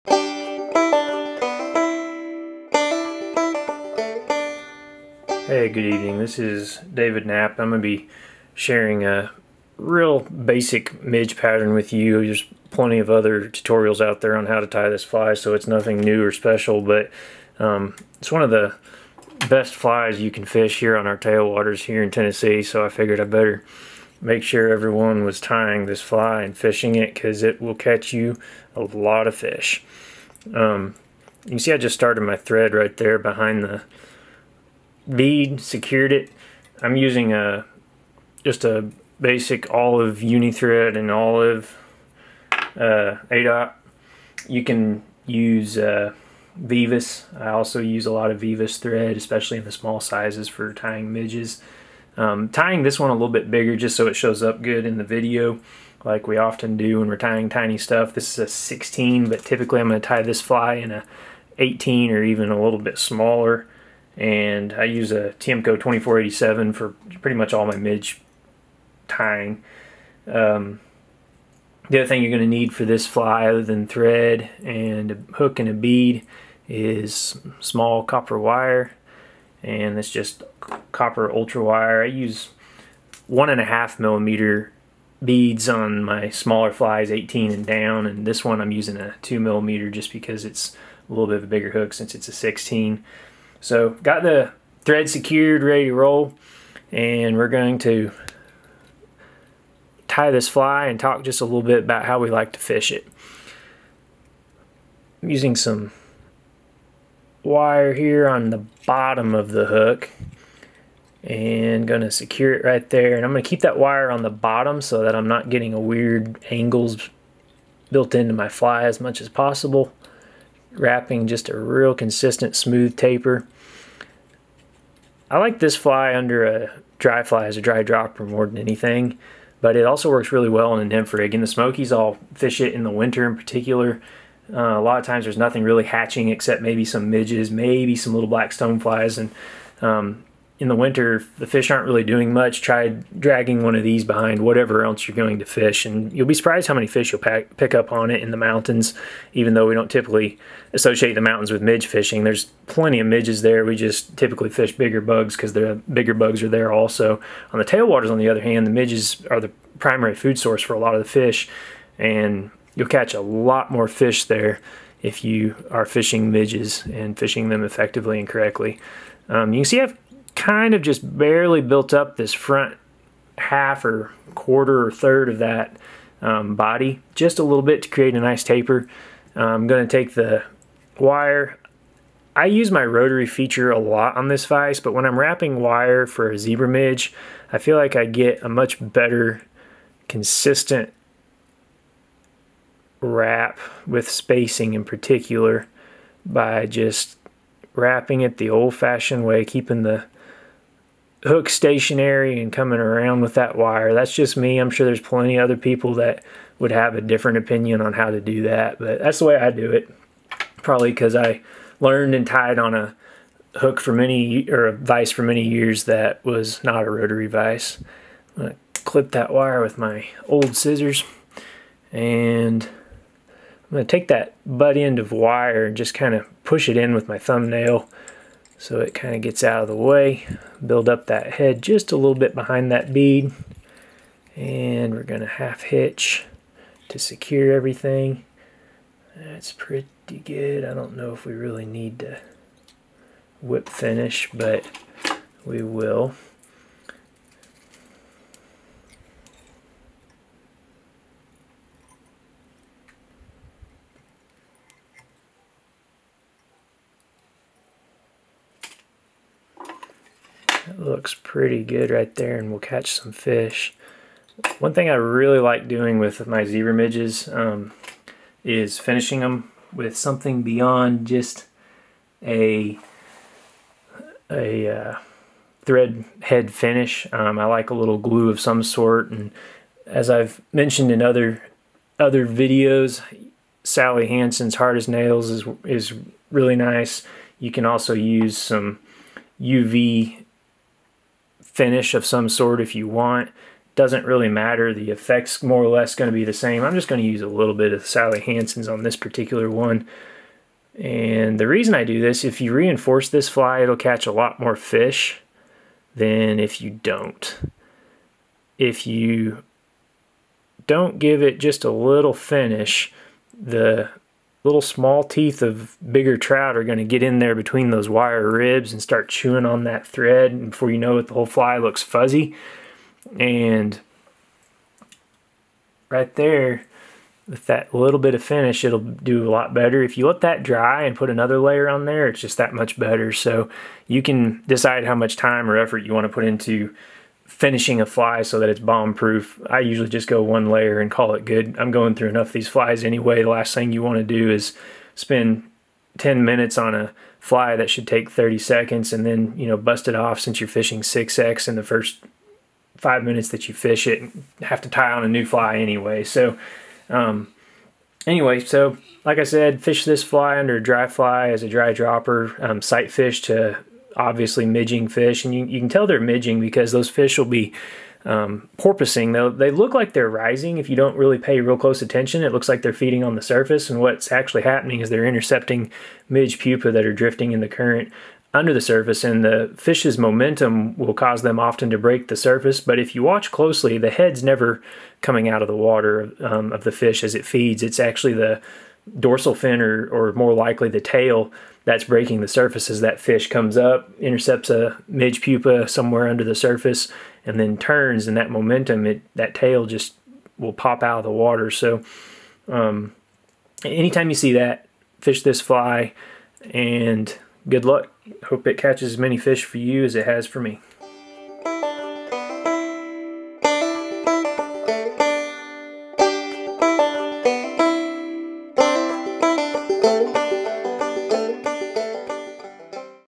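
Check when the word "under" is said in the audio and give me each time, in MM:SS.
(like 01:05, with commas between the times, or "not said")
02:06, 06:00, 06:18, 06:36.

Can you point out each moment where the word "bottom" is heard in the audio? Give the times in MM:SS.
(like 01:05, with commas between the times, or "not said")
01:48, 01:54.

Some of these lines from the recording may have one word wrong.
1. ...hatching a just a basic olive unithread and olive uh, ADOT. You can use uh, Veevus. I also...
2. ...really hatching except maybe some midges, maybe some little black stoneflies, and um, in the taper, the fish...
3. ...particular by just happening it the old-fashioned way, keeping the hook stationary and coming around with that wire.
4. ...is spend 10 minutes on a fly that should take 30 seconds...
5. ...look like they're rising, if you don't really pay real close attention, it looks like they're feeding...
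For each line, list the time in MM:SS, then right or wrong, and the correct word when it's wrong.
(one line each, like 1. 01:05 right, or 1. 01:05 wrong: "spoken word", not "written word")
1. 00:36 wrong: "using", not "hatching"
2. 02:15 wrong: "winter", not "taper"
3. 03:14 wrong: "wrapping", not "happening"
4. 05:44 right
5. 06:09 right.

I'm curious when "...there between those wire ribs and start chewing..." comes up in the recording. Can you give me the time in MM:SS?
05:17.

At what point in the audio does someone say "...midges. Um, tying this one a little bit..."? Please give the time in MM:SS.
00:51.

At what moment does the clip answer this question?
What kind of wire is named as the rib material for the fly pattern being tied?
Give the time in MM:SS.
01:20.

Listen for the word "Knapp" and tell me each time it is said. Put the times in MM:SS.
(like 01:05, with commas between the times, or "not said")
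00:07.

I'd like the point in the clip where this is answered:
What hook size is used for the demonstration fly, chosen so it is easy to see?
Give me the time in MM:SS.
00:58.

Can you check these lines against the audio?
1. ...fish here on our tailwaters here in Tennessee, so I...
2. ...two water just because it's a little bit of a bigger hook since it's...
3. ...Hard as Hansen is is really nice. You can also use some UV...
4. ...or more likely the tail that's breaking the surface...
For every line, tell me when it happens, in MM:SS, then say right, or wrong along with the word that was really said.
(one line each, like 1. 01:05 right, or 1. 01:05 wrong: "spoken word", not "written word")
1. 00:20 right
2. 01:29 wrong: "millimeter", not "water"
3. 04:44 wrong: "Nails", not "Hansen"
4. 06:29 right.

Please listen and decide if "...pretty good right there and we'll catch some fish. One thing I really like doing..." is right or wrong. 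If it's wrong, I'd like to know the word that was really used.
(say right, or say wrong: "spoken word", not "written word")
right.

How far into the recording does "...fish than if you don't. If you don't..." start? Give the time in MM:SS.
05:04.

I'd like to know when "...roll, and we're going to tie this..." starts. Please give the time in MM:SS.
01:35.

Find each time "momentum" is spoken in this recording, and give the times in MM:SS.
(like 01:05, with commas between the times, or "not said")
06:19, 06:38.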